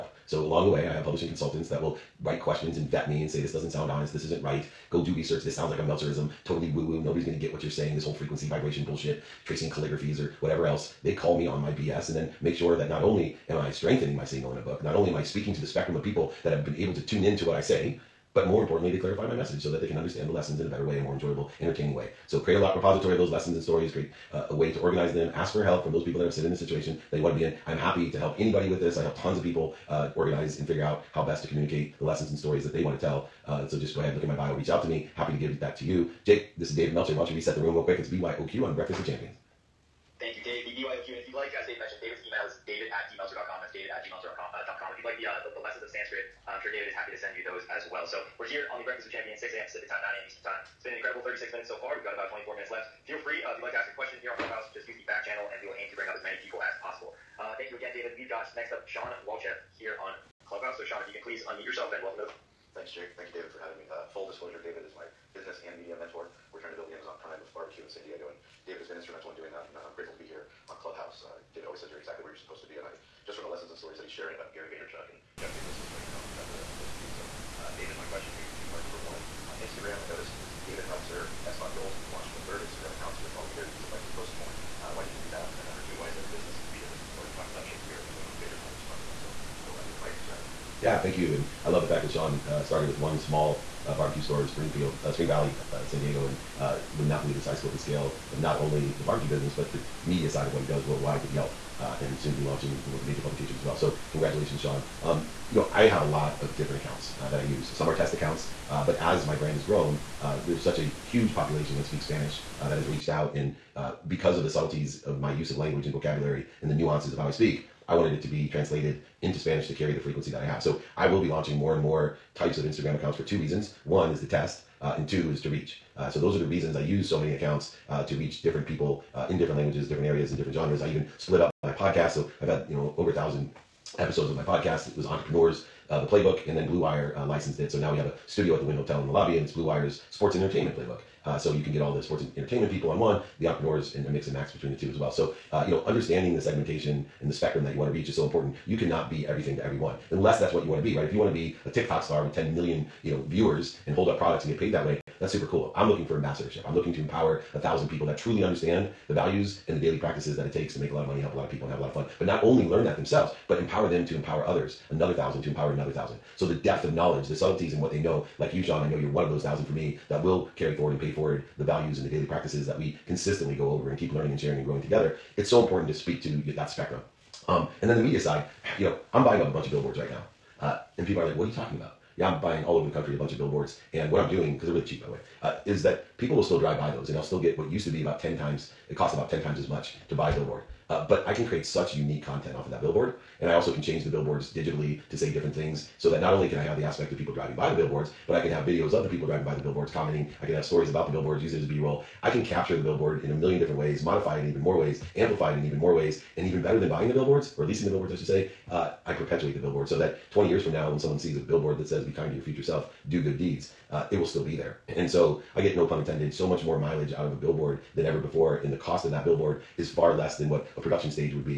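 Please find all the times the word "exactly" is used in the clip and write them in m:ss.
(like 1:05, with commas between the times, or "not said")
1:11, 1:16.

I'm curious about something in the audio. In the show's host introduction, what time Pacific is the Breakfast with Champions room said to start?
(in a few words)
6 a.m.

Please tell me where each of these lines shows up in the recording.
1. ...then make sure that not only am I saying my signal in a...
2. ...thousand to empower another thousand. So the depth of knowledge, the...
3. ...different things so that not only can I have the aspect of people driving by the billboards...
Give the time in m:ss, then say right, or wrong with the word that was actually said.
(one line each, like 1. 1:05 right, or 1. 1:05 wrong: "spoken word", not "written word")
1. 0:12 wrong: "strengthening", not "saying"
2. 2:45 right
3. 3:15 right.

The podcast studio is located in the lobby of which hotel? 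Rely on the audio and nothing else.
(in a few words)
Wynn Hotel.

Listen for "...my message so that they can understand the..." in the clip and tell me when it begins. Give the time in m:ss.
0:19.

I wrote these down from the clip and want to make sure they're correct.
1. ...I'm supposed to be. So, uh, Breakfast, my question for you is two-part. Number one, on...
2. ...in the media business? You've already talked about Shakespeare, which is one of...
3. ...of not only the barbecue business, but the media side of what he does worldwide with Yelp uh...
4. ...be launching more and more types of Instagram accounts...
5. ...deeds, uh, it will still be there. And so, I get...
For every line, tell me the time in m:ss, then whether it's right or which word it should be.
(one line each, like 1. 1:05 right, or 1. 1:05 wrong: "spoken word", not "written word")
1. 1:16 wrong: "David", not "Breakfast"
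2. 1:26 right
3. 1:38 right
4. 2:01 right
5. 3:33 right.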